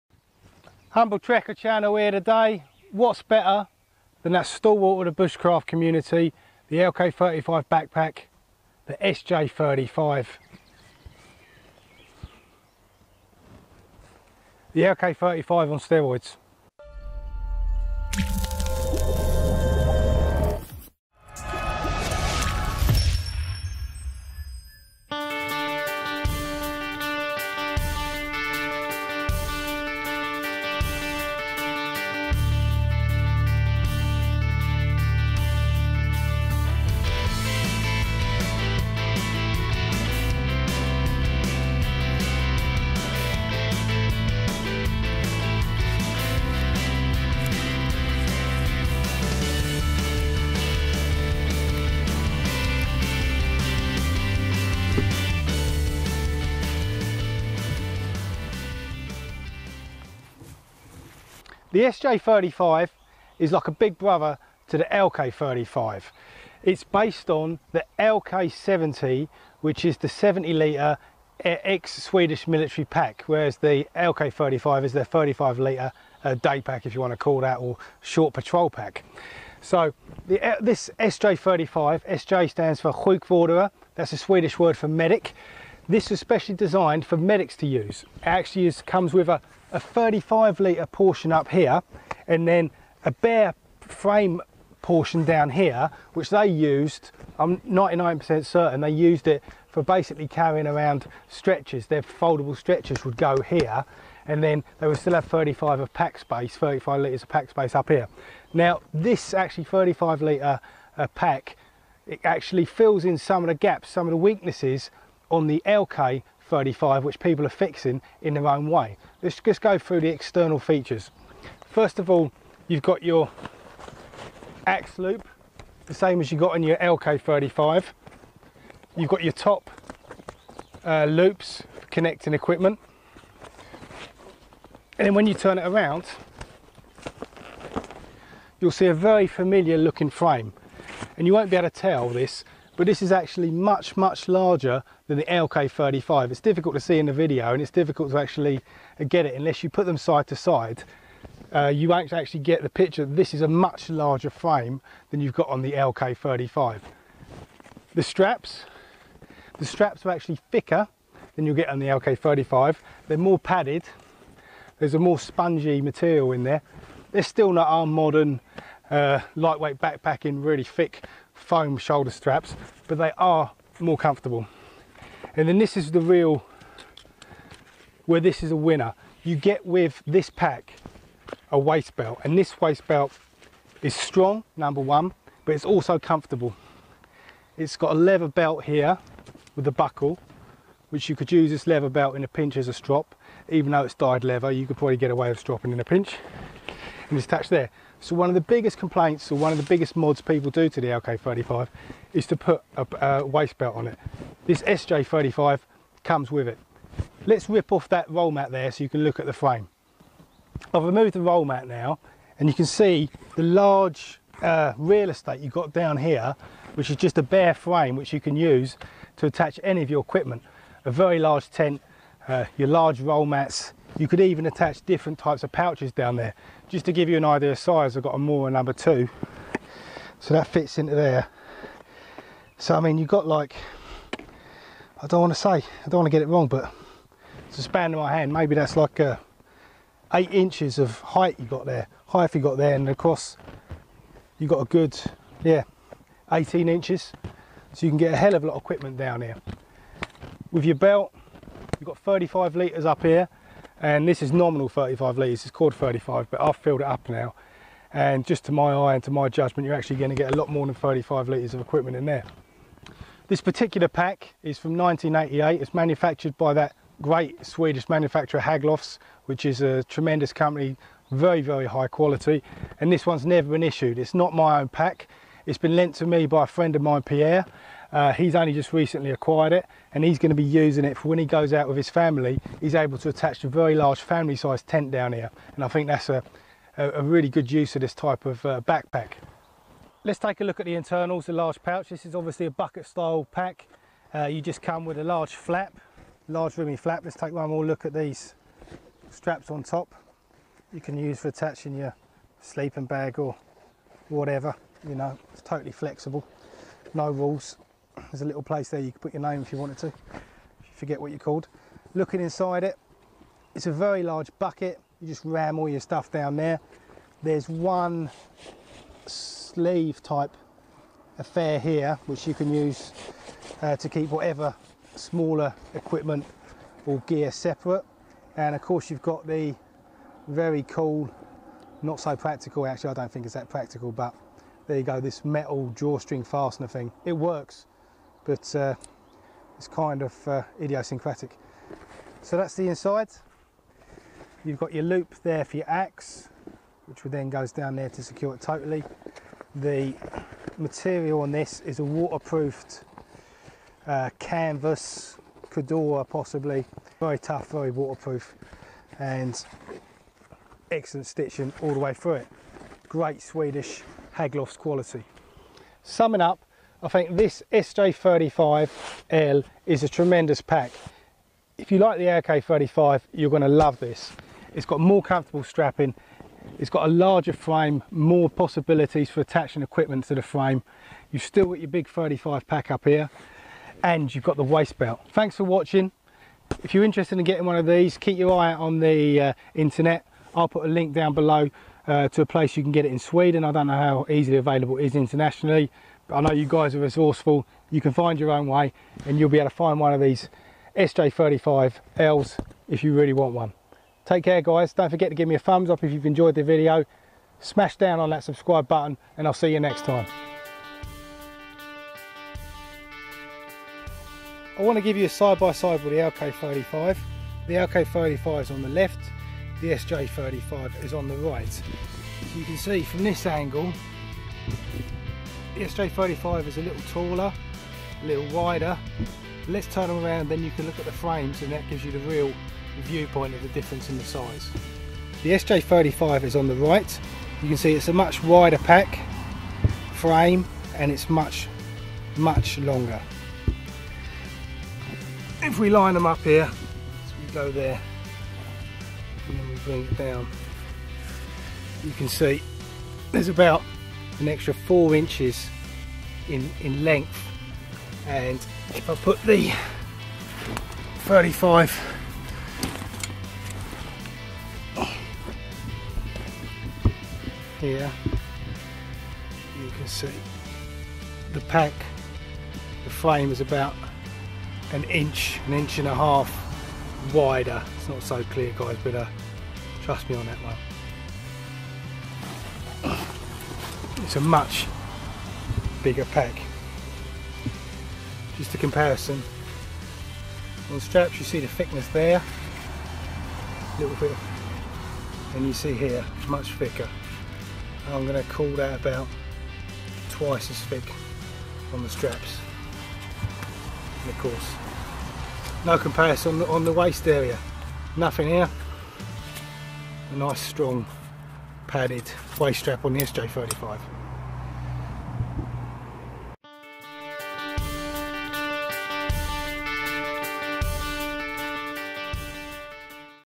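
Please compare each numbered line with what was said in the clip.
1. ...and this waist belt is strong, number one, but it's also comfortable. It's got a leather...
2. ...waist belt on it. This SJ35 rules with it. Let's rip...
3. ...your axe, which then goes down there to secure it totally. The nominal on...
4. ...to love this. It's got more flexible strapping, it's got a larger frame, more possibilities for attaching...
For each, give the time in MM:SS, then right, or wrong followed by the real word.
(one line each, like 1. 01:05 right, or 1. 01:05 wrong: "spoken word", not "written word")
1. 03:02 right
2. 03:23 wrong: "comes", not "rules"
3. 05:45 wrong: "material", not "nominal"
4. 06:13 wrong: "comfortable", not "flexible".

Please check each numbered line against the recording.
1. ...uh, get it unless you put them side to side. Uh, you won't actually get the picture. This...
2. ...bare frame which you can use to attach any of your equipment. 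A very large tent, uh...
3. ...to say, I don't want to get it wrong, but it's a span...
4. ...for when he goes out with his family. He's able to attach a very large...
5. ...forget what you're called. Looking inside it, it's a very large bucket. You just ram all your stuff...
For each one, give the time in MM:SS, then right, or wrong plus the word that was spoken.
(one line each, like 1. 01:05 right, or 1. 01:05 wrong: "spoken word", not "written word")
1. 02:28 right
2. 03:37 right
3. 03:55 right
4. 04:40 right
5. 05:10 right.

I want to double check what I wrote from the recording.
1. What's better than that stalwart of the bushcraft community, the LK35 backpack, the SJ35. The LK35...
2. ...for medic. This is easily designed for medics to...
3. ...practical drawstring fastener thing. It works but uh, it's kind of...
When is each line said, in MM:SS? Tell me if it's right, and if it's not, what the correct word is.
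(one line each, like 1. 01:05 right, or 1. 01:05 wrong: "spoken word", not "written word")
1. 00:02 right
2. 01:24 wrong: "specially", not "easily"
3. 05:35 wrong: "metal", not "practical".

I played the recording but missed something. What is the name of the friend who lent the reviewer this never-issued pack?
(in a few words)
Pierre.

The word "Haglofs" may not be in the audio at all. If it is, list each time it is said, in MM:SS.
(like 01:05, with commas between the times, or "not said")
04:28, 06:04.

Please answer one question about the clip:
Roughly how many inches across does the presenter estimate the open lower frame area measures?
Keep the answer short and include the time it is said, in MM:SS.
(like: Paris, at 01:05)
18 inches, at 04:06.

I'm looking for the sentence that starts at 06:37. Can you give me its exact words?
You can find your own way and you'll be able to find one of these SJ35Ls if you really want one.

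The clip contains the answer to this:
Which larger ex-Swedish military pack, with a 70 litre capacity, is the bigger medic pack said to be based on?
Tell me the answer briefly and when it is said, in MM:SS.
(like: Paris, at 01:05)
LK70, at 01:07.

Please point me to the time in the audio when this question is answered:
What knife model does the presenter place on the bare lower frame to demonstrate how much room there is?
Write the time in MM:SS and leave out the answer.
03:48.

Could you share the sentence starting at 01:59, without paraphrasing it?
Let's just go through the external features.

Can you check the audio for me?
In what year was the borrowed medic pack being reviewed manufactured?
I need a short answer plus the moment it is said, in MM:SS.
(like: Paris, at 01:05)
1988, at 04:24.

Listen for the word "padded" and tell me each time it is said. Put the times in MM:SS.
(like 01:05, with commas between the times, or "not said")
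02:43, 08:31.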